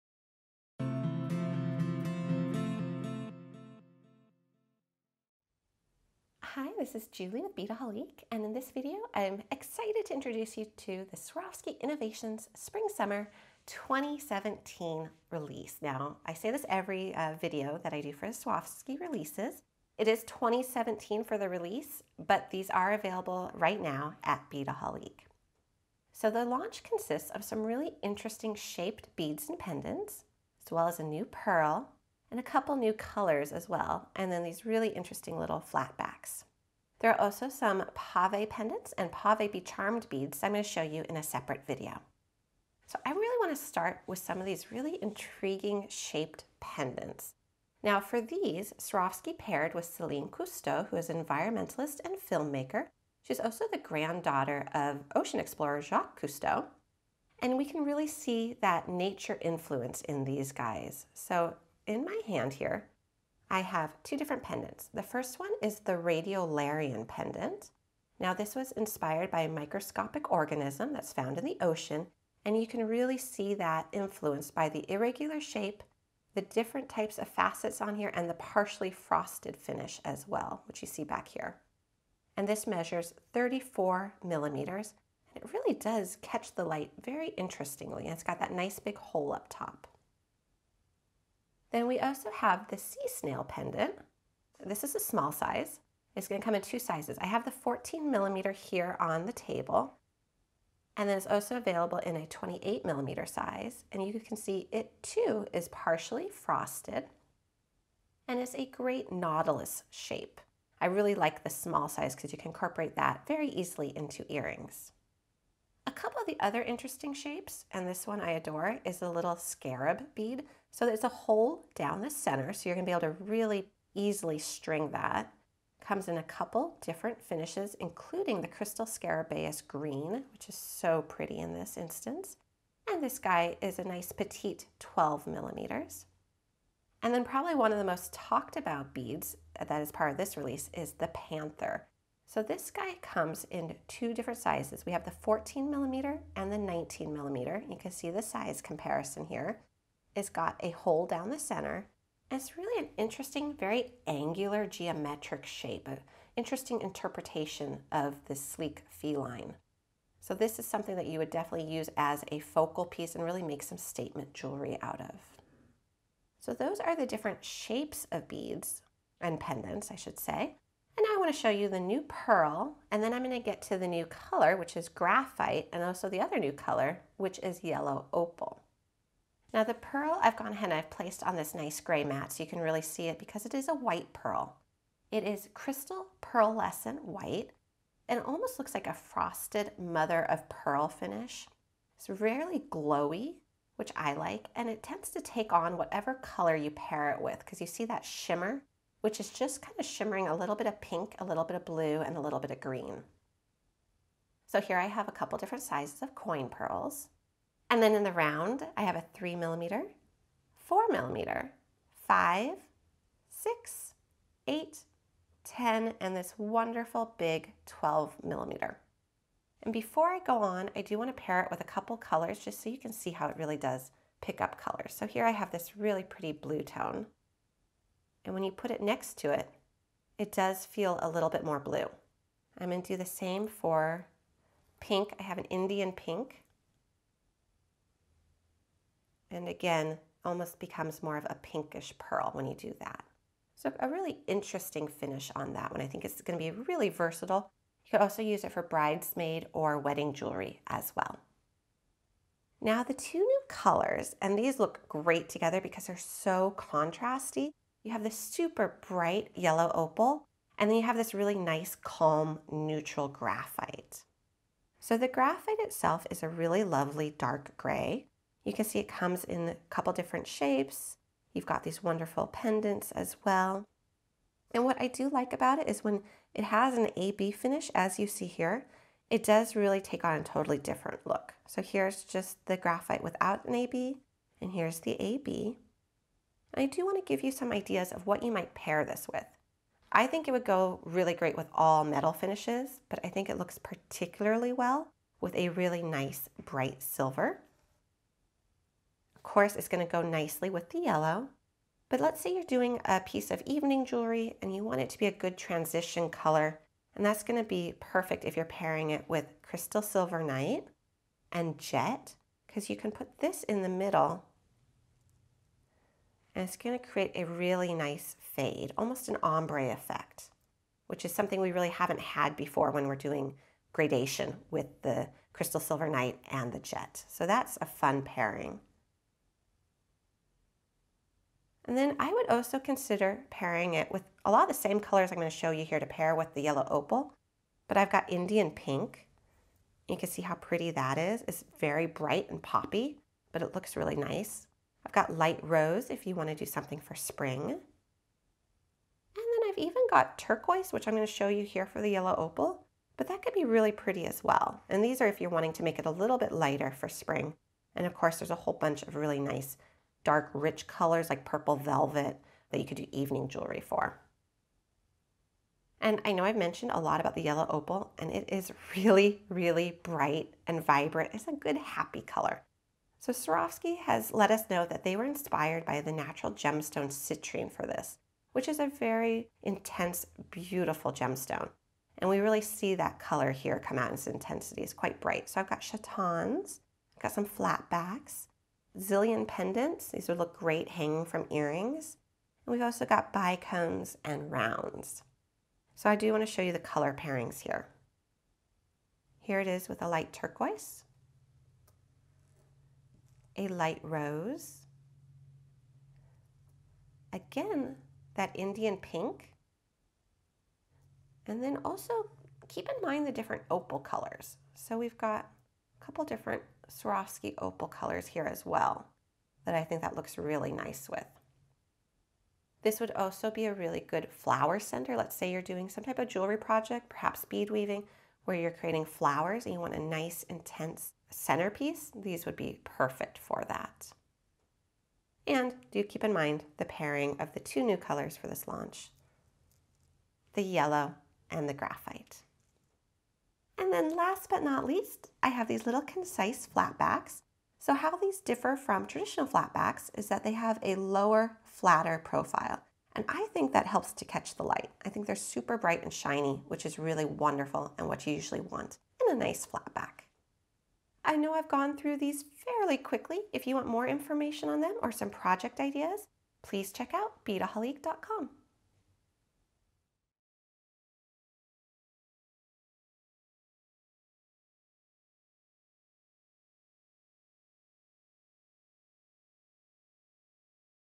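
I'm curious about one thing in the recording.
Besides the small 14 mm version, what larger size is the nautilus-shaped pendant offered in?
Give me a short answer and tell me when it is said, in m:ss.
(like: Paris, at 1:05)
28 millimeters, at 1:42.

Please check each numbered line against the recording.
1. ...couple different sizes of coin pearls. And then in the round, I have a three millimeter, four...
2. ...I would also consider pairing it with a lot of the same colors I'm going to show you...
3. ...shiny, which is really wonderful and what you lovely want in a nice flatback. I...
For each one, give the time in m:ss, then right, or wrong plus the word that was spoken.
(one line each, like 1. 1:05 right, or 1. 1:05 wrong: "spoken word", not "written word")
1. 3:25 right
2. 5:31 right
3. 7:35 wrong: "usually", not "lovely".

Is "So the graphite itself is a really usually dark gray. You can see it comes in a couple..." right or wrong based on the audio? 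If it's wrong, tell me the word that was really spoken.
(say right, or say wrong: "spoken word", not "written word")
wrong: "lovely", not "usually".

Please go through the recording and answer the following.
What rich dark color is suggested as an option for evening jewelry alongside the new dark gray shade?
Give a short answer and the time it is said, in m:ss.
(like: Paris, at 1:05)
purple velvet, at 6:01.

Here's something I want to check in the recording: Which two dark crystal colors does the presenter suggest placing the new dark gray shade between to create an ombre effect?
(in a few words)
Crystal Silver Night and Jet.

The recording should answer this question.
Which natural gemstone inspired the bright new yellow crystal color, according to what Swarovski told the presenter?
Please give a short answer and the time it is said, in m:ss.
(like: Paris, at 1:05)
citrine, at 6:16.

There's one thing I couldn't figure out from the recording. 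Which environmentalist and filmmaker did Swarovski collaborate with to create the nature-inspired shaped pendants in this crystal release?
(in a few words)
Celine Cousteau.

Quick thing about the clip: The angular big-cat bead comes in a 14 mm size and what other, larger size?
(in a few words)
19 millimeters.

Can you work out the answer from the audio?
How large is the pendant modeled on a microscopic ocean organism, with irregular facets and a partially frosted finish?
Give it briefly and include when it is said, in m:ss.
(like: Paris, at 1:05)
34 millimeters, at 1:23.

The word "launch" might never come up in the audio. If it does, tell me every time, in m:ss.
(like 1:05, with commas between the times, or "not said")
0:26, 7:18.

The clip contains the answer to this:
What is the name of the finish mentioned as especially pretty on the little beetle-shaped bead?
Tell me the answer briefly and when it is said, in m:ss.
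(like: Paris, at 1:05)
Crystal Scarabaeus Green, at 2:08.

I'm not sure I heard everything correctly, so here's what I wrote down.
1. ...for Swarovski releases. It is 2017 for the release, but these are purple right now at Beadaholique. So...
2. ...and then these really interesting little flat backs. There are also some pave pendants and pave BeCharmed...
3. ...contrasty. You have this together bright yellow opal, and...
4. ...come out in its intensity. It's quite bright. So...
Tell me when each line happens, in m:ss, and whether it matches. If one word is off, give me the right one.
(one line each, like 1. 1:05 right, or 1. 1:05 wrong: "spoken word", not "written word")
1. 0:18 wrong: "available", not "purple"
2. 0:34 right
3. 4:16 wrong: "super", not "together"
4. 6:23 right.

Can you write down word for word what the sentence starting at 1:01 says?
So in my hand here, I have two different pendants.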